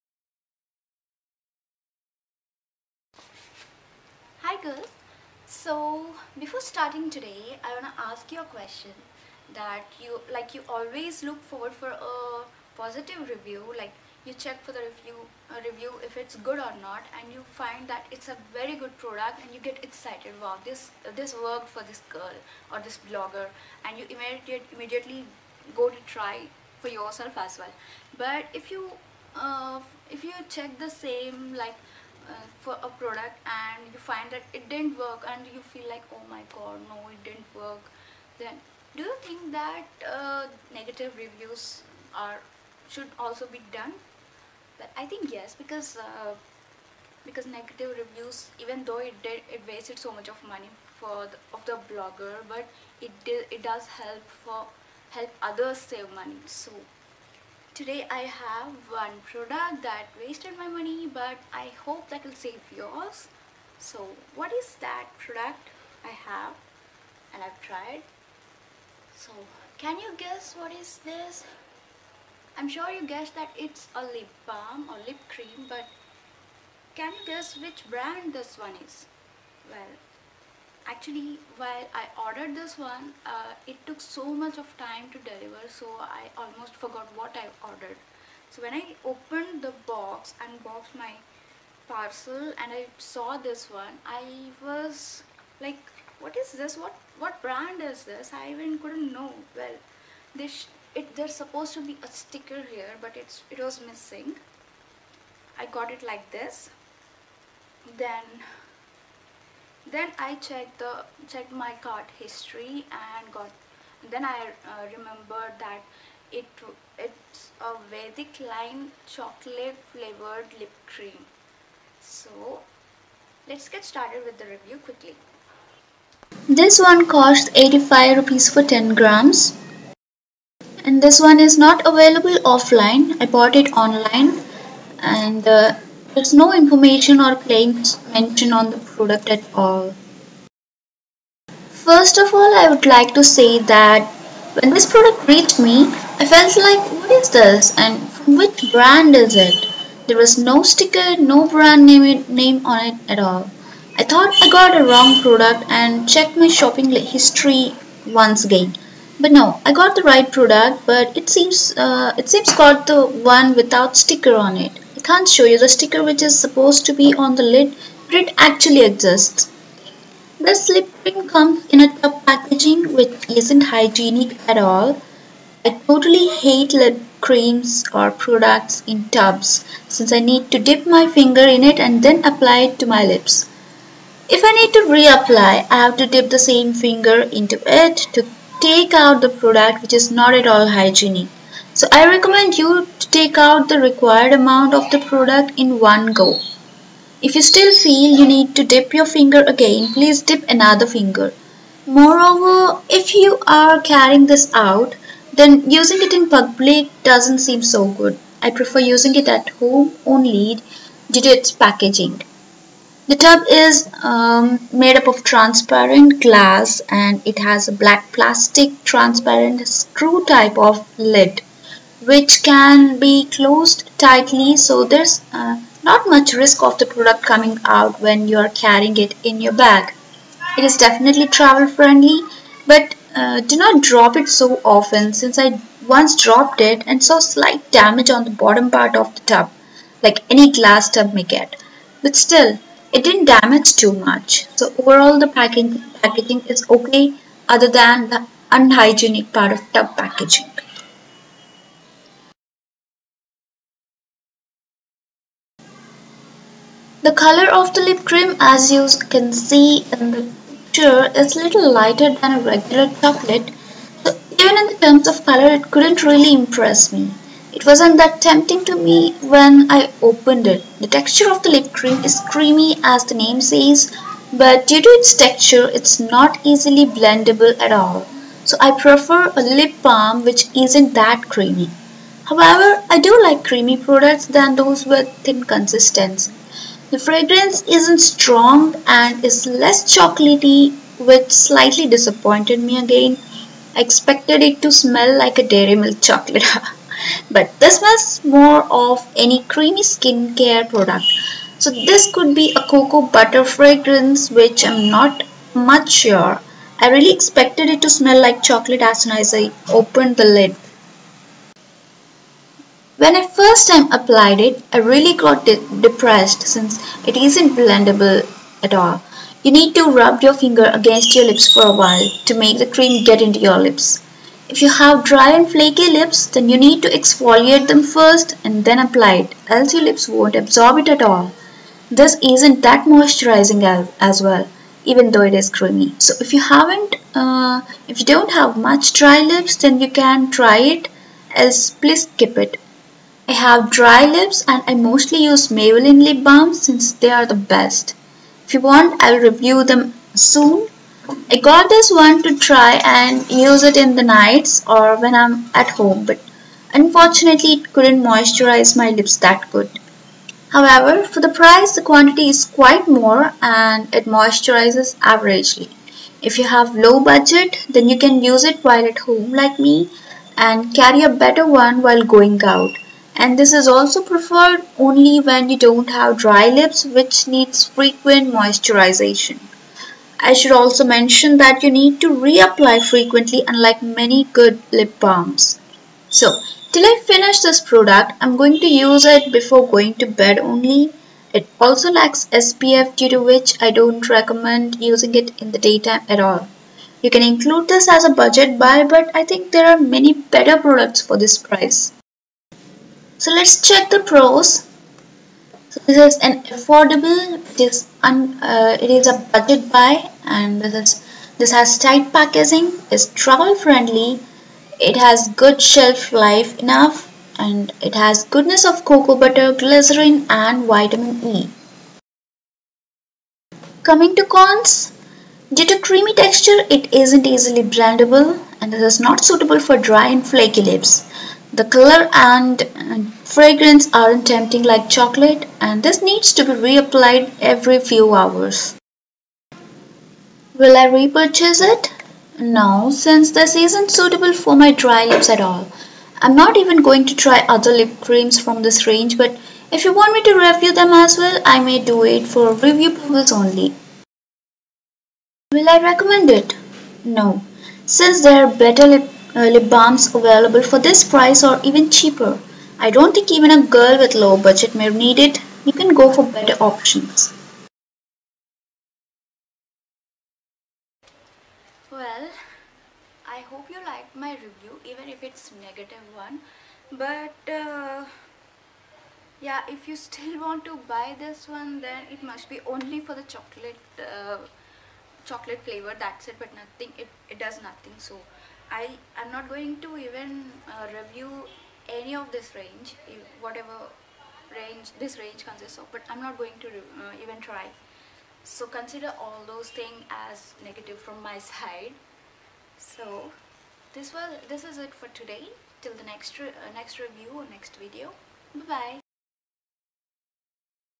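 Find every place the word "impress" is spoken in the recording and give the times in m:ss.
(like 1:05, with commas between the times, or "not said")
4:26.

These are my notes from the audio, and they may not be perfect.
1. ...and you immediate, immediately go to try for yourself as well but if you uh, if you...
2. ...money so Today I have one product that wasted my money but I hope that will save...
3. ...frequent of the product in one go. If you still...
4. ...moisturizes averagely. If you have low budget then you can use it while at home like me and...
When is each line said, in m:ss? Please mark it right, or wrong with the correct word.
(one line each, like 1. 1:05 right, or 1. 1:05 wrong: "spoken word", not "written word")
1. 0:23 right
2. 0:56 right
3. 3:14 wrong: "amount", not "frequent"
4. 6:04 right.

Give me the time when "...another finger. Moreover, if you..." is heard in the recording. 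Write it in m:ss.
3:20.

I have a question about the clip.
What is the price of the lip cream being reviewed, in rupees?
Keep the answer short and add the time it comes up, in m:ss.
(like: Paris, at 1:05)
85 rupees, at 2:07.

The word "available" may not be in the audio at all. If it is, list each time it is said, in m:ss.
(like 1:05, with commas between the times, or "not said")
2:11, 7:40.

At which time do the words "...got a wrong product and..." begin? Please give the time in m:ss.
2:34.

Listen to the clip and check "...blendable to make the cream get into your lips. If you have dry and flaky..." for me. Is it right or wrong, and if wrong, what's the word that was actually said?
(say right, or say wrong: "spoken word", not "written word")
wrong: "while", not "blendable".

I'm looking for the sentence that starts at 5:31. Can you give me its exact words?
This isn't that moisturizing as well, even though it is creamy.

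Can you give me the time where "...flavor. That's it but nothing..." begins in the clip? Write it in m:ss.
8:05.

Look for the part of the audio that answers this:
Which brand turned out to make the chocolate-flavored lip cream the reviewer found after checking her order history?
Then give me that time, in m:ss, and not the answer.
1:57.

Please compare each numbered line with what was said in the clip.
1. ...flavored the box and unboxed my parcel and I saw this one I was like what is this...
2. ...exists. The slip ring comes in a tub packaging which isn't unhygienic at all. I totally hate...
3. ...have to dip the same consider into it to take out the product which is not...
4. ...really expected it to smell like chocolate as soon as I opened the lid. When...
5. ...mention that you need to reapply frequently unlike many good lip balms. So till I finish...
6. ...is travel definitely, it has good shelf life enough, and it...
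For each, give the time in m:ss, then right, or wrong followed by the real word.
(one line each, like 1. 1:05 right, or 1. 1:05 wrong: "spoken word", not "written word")
1. 1:29 wrong: "opened", not "flavored"
2. 2:48 wrong: "hygienic", not "unhygienic"
3. 3:05 wrong: "finger", not "consider"
4. 5:06 right
5. 6:20 right
6. 6:52 wrong: "friendly", not "definitely".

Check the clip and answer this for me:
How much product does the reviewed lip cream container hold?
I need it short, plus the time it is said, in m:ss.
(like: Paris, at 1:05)
10 grams, at 2:08.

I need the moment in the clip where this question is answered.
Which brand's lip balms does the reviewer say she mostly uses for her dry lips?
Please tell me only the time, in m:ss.
5:45.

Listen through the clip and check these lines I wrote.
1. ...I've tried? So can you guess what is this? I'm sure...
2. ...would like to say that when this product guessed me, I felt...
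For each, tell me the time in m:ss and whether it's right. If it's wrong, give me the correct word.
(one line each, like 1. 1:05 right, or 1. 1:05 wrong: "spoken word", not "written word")
1. 1:07 right
2. 2:22 wrong: "reached", not "guessed".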